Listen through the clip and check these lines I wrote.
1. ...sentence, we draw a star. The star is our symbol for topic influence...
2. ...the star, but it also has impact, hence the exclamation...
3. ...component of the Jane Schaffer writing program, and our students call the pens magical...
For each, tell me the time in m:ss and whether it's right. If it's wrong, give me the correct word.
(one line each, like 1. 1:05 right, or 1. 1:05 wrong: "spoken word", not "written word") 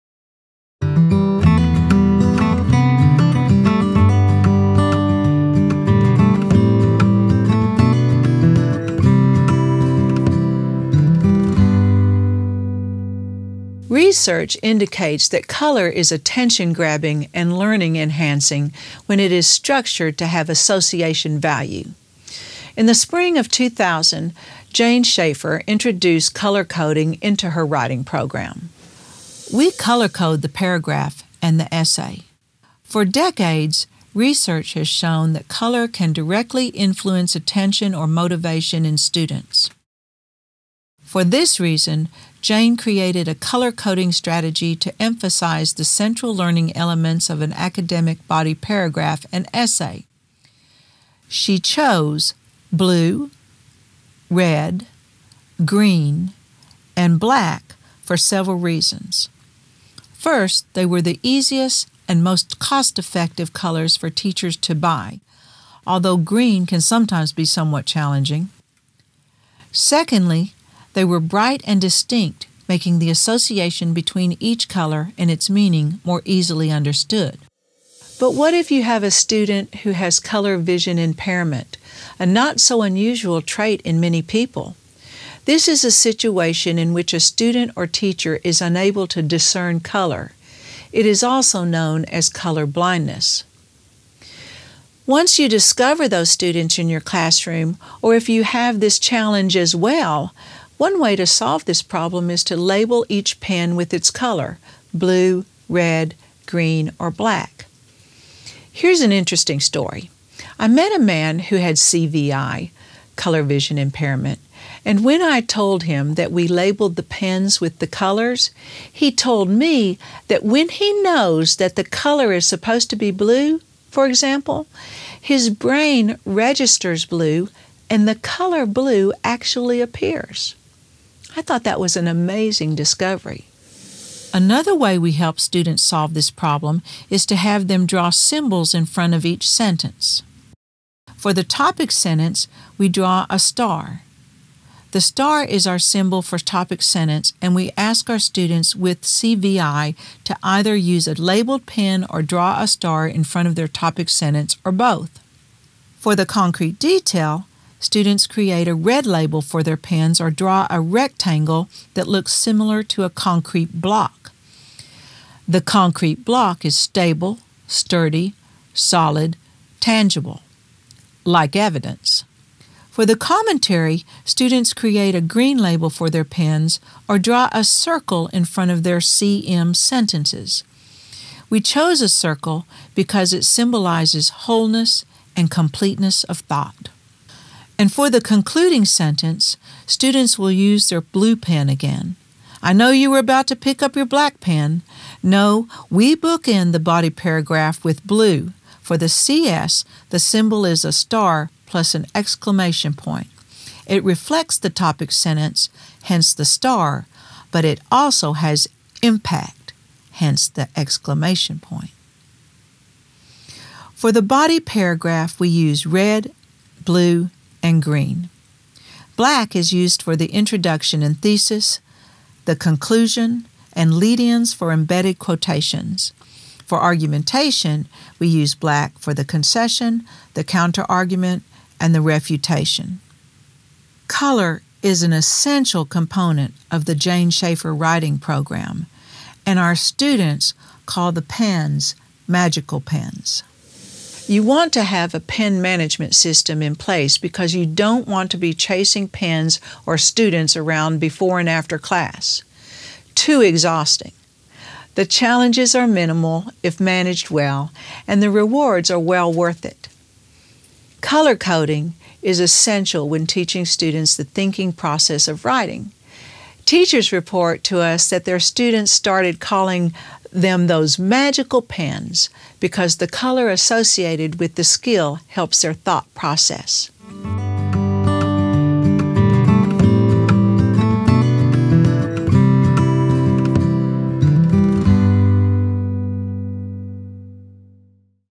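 1. 2:21 wrong: "sentence", not "influence"
2. 3:26 right
3. 3:55 right.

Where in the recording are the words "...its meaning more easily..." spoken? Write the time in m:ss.
1:15.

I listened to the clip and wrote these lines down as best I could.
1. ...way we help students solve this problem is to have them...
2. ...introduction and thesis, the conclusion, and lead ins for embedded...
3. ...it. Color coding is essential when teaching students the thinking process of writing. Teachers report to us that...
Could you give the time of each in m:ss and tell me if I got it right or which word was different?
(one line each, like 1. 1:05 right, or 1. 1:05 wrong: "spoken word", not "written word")
1. 2:14 right
2. 3:40 right
3. 4:19 right.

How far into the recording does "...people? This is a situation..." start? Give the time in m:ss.
1:24.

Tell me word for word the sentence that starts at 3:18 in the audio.
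For the CS, the symbol is a star plus an exclamation point.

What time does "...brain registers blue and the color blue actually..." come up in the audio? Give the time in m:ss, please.
2:05.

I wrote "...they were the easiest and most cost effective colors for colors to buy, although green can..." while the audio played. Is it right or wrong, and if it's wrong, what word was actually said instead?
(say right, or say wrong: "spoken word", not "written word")
wrong: "teachers", not "colors".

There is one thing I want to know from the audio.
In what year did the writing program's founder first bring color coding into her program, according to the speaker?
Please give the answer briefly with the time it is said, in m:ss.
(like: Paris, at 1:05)
2000, at 0:23.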